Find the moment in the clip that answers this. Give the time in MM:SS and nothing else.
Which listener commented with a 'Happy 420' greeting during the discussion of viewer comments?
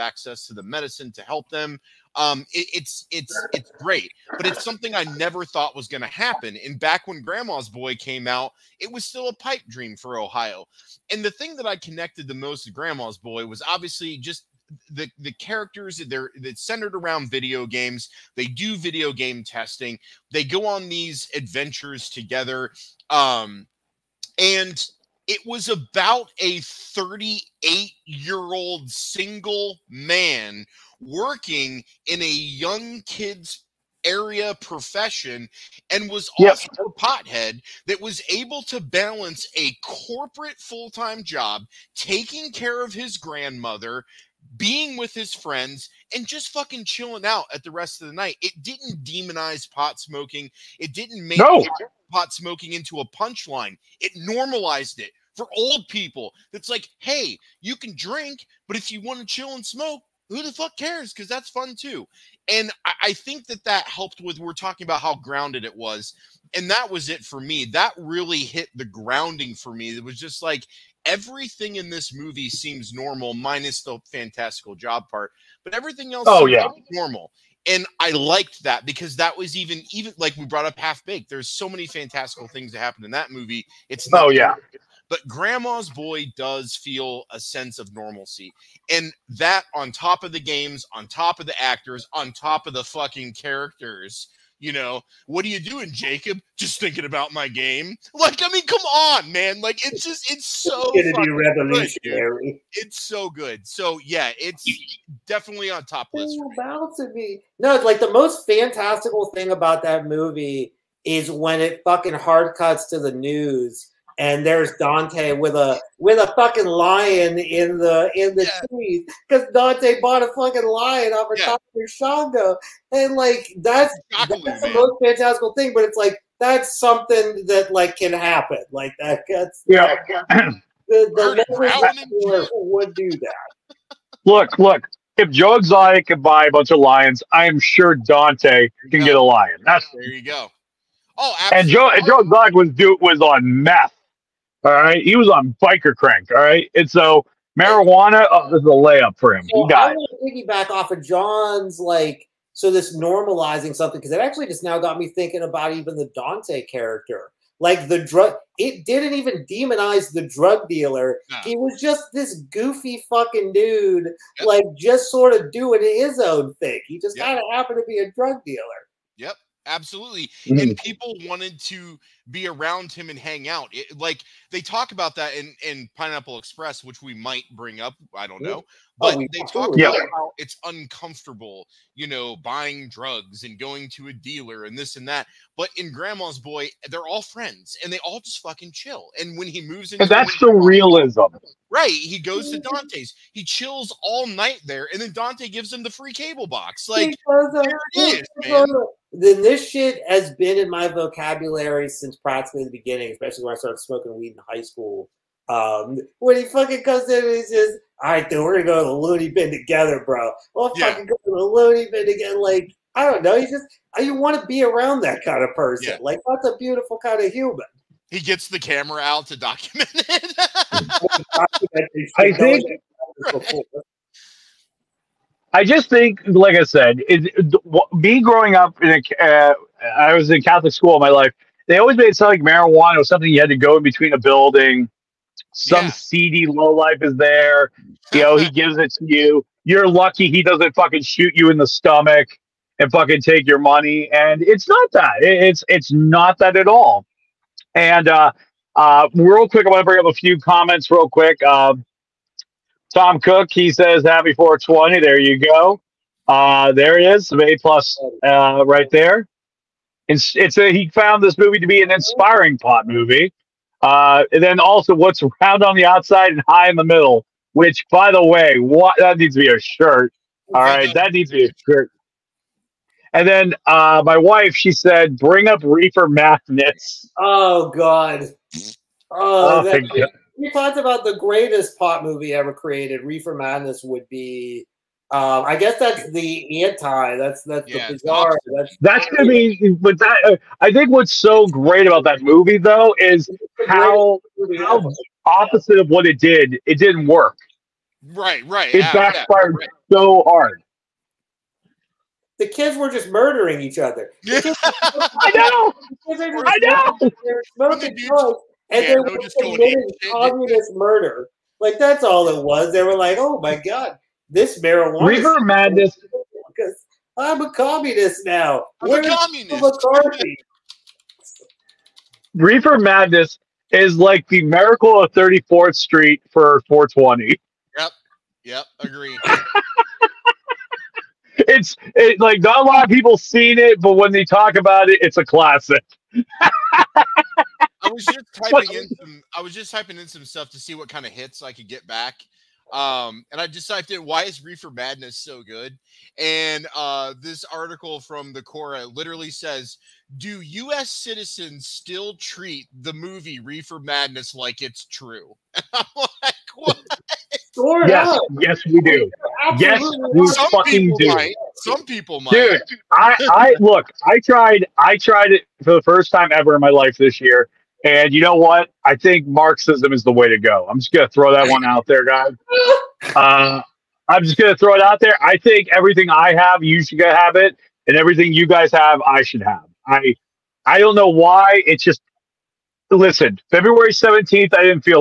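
04:12.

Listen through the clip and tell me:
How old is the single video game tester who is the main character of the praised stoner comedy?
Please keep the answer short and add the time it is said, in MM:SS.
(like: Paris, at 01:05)
38, at 00:26.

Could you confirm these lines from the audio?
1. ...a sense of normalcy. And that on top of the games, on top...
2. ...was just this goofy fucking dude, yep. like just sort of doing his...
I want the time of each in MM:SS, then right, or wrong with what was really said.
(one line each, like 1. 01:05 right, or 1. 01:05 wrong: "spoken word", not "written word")
1. 01:27 right
2. 02:41 right.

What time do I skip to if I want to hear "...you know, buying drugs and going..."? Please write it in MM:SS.
03:01.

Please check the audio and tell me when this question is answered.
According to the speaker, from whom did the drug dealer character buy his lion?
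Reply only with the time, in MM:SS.
02:01.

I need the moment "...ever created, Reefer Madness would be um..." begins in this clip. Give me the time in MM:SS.
04:42.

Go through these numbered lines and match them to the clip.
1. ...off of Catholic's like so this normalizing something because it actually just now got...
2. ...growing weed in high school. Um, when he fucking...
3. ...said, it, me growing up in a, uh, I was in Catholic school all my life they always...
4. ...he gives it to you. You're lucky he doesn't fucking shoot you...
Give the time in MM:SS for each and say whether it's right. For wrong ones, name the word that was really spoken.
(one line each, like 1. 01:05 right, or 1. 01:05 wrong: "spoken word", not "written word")
1. 02:30 wrong: "John", not "Catholic"
2. 03:23 wrong: "smoking", not "growing"
3. 03:46 right
4. 03:58 right.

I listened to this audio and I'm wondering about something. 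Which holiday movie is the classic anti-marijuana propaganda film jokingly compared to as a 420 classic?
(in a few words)
Miracle on 34th Street.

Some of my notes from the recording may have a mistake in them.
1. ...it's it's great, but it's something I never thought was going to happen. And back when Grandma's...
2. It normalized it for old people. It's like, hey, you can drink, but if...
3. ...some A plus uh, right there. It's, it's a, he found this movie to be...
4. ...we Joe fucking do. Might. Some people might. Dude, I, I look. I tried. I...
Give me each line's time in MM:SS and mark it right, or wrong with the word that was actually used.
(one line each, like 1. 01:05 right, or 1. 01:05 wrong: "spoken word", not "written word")
1. 00:03 right
2. 00:53 right
3. 04:17 right
4. 06:00 wrong: "Some", not "Joe".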